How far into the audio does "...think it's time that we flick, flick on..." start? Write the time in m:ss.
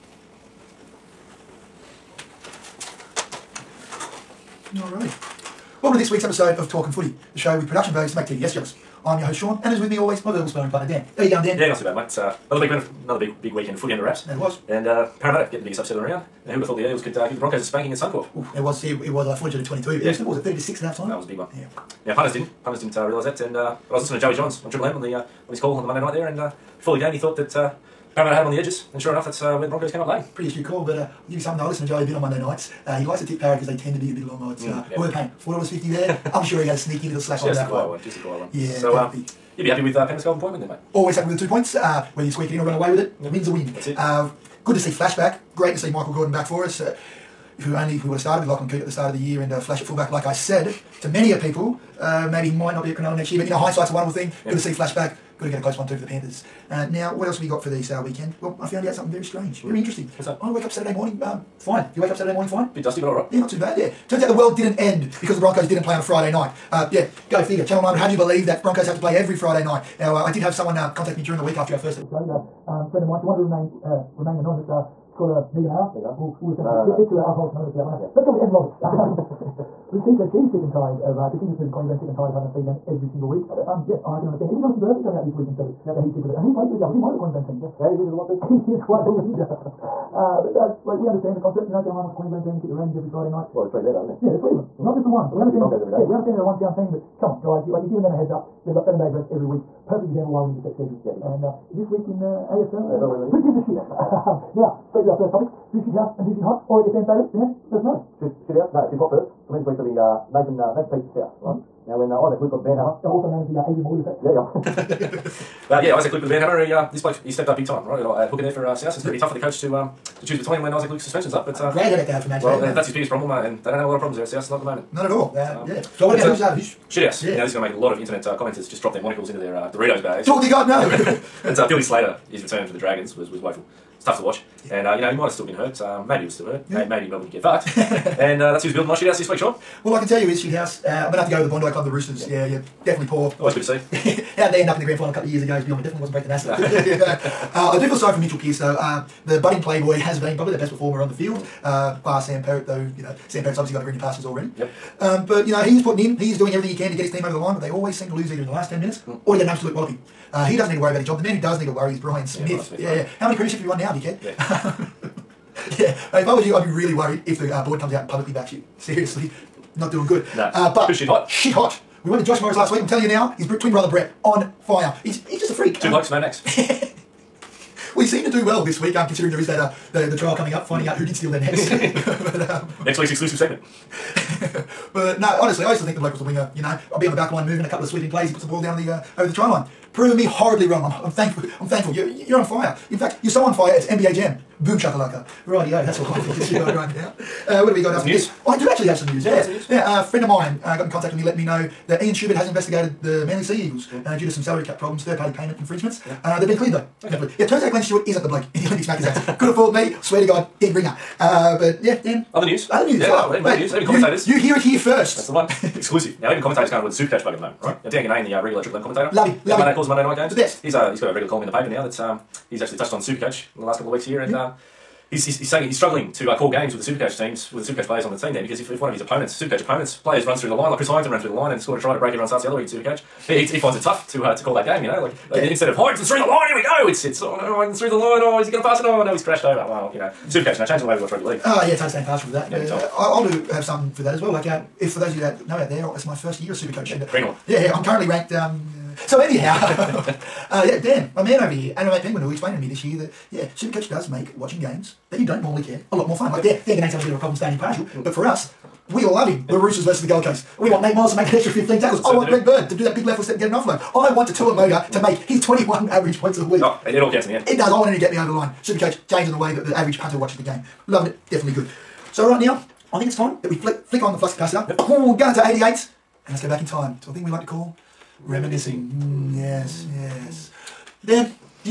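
4:32.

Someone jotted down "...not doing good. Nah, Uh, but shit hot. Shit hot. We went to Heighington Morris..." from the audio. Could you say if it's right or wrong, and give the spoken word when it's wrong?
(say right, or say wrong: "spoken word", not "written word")
wrong: "Josh", not "Heighington".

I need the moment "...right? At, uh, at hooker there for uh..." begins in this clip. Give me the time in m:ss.
1:57.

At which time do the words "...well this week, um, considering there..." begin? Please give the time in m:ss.
2:58.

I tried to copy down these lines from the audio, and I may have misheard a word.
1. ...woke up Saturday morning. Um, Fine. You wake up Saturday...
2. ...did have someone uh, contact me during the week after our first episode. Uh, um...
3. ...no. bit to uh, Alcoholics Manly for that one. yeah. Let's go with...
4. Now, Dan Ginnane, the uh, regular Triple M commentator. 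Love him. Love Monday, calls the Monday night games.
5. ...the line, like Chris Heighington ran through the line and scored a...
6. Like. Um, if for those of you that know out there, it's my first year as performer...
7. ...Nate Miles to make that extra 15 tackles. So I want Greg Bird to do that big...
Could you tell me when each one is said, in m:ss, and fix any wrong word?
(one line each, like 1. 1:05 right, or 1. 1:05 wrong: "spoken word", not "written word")
1. 1:00 right
2. 1:10 right
3. 1:16 wrong: "Anonymous", not "Manly"
4. 3:37 right
5. 3:50 right
6. 4:04 wrong: "super", not "performer"
7. 4:20 right.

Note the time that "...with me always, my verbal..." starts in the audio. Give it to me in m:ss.
0:09.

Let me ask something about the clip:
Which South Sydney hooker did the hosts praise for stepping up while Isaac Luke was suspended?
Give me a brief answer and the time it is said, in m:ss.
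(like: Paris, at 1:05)
Nathan Peats, at 1:50.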